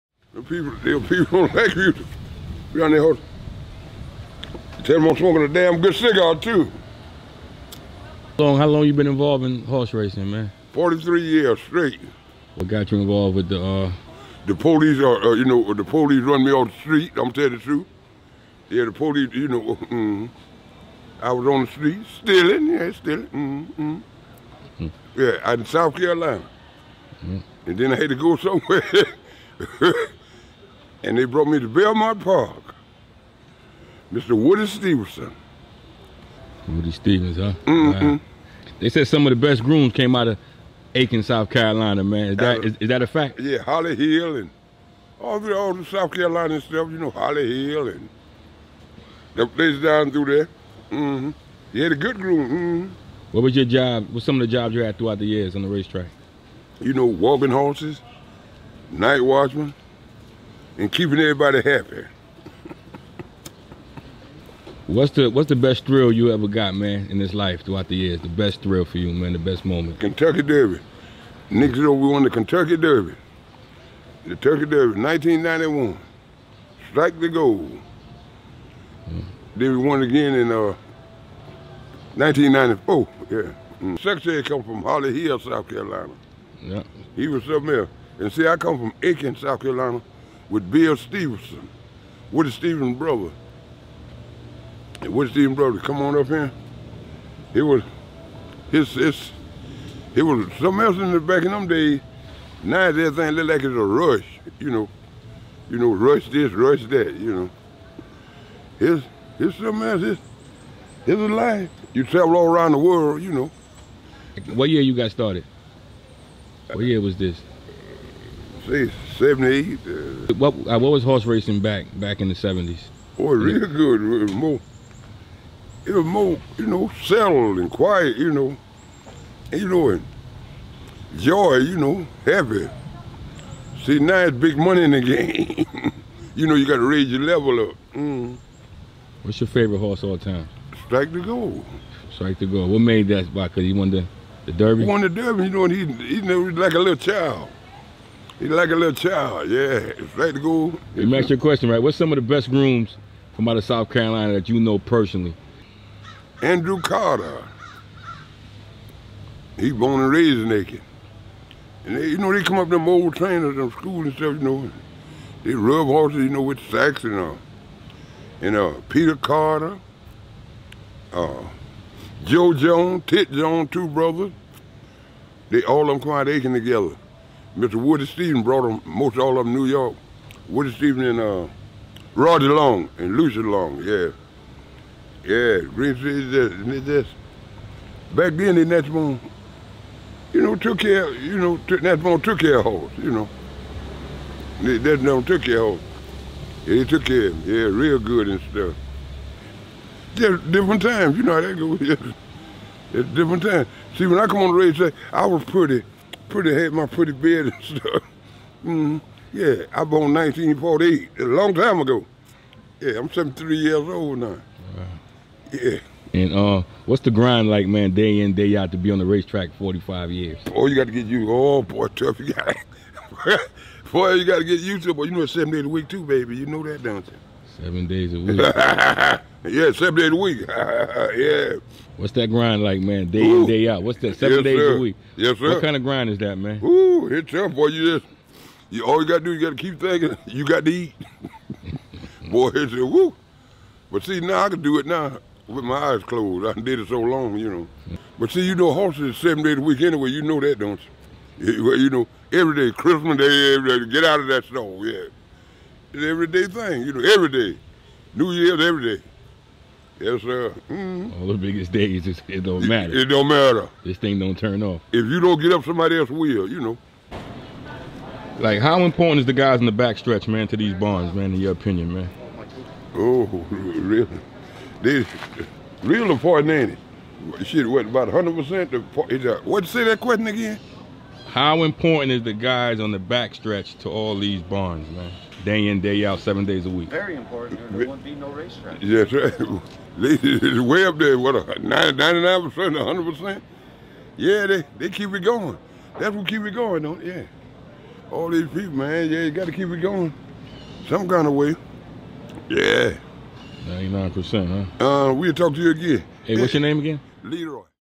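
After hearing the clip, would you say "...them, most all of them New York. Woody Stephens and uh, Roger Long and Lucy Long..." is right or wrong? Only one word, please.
right.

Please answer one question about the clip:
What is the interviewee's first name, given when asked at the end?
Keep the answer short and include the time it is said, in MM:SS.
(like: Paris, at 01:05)
Leroy, at 05:07.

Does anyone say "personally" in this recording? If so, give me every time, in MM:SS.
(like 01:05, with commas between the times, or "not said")
02:34.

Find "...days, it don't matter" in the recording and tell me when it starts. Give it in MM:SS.
04:21.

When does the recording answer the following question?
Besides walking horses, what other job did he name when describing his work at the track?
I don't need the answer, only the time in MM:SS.
00:58.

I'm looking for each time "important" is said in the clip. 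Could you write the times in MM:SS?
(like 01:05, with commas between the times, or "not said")
04:28, 04:36, 04:41, 04:47.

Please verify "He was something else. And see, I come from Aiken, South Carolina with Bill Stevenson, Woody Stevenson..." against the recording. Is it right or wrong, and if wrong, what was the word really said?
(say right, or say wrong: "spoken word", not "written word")
right.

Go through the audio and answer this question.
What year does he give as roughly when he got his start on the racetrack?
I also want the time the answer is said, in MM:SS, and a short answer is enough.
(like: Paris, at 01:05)
1978, at 01:59.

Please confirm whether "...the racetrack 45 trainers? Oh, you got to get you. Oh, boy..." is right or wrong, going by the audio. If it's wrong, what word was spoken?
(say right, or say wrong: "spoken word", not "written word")
wrong: "years", not "trainers".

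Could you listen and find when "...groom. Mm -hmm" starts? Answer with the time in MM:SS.
00:52.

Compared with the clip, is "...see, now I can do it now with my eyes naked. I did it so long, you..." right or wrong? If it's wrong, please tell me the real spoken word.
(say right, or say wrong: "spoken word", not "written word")
wrong: "closed", not "naked".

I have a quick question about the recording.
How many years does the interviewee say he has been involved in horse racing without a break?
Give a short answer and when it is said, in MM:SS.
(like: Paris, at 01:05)
43, at 00:10.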